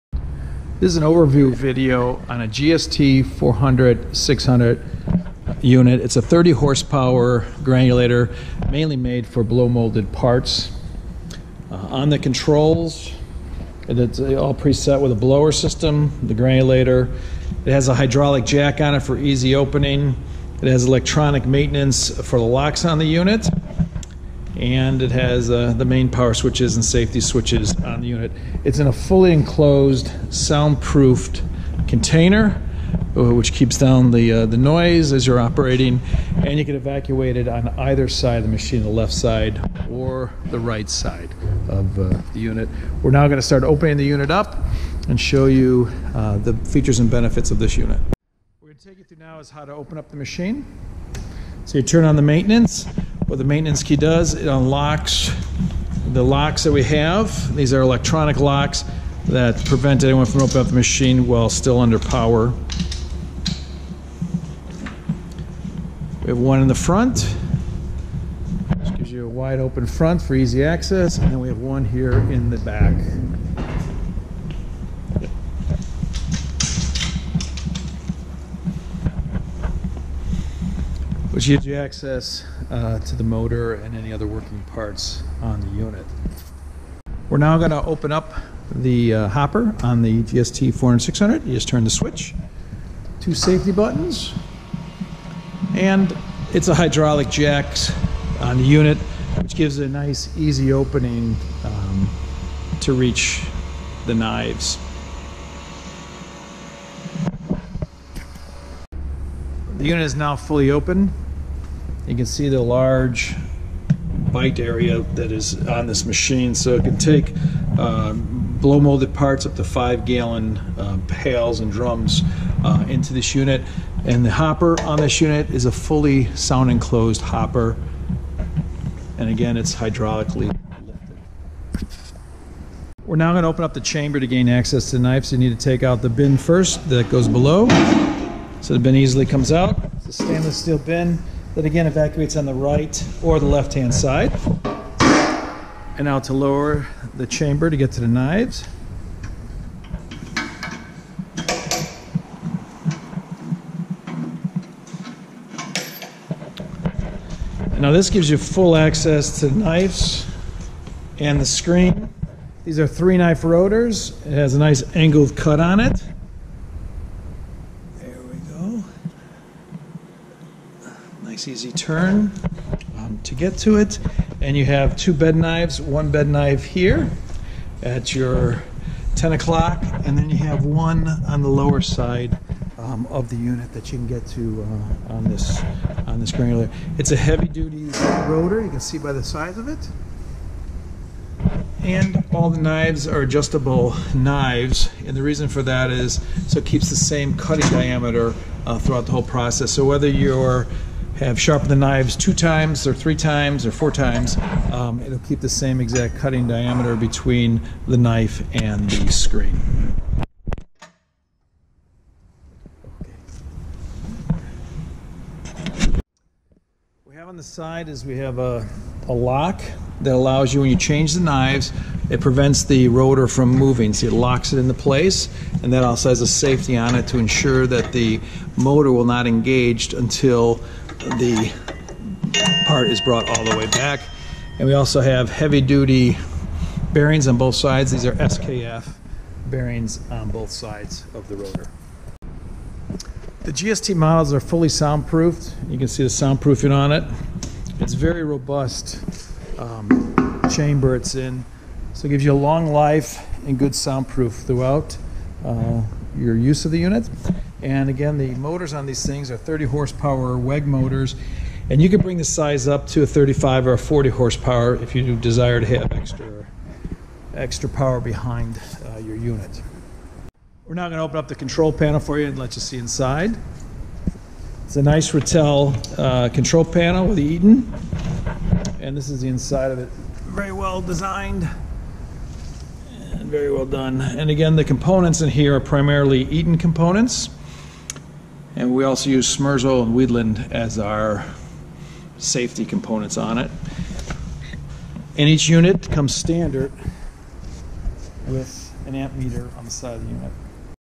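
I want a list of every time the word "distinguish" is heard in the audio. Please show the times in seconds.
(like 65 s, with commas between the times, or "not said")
not said.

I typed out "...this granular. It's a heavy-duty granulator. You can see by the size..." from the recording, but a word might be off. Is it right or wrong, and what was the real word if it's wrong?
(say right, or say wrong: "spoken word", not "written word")
wrong: "rotor", not "granulator".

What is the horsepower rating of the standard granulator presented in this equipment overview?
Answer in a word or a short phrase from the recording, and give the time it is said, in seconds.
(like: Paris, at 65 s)
30, at 6 s.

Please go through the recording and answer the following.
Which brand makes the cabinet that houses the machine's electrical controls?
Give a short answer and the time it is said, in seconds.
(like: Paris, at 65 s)
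Rittal, at 275 s.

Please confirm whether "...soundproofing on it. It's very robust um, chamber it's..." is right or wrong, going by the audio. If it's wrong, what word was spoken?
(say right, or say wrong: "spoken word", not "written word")
right.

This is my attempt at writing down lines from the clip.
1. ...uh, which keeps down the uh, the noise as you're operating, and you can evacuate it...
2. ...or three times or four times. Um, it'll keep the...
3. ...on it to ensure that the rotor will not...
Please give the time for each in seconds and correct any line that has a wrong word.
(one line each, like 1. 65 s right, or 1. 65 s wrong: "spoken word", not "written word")
1. 33 s right
2. 202 s right
3. 226 s wrong: "motor", not "rotor".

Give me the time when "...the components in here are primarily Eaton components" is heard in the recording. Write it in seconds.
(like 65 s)
284 s.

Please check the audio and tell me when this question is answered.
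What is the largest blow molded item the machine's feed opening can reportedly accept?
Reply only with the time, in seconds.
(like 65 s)
119 s.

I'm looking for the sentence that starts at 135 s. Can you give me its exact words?
You need to take out the bin first that goes below.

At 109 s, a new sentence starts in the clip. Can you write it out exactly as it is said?
The unit is now fully open.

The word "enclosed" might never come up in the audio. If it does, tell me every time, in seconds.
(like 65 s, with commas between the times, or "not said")
29 s, 126 s.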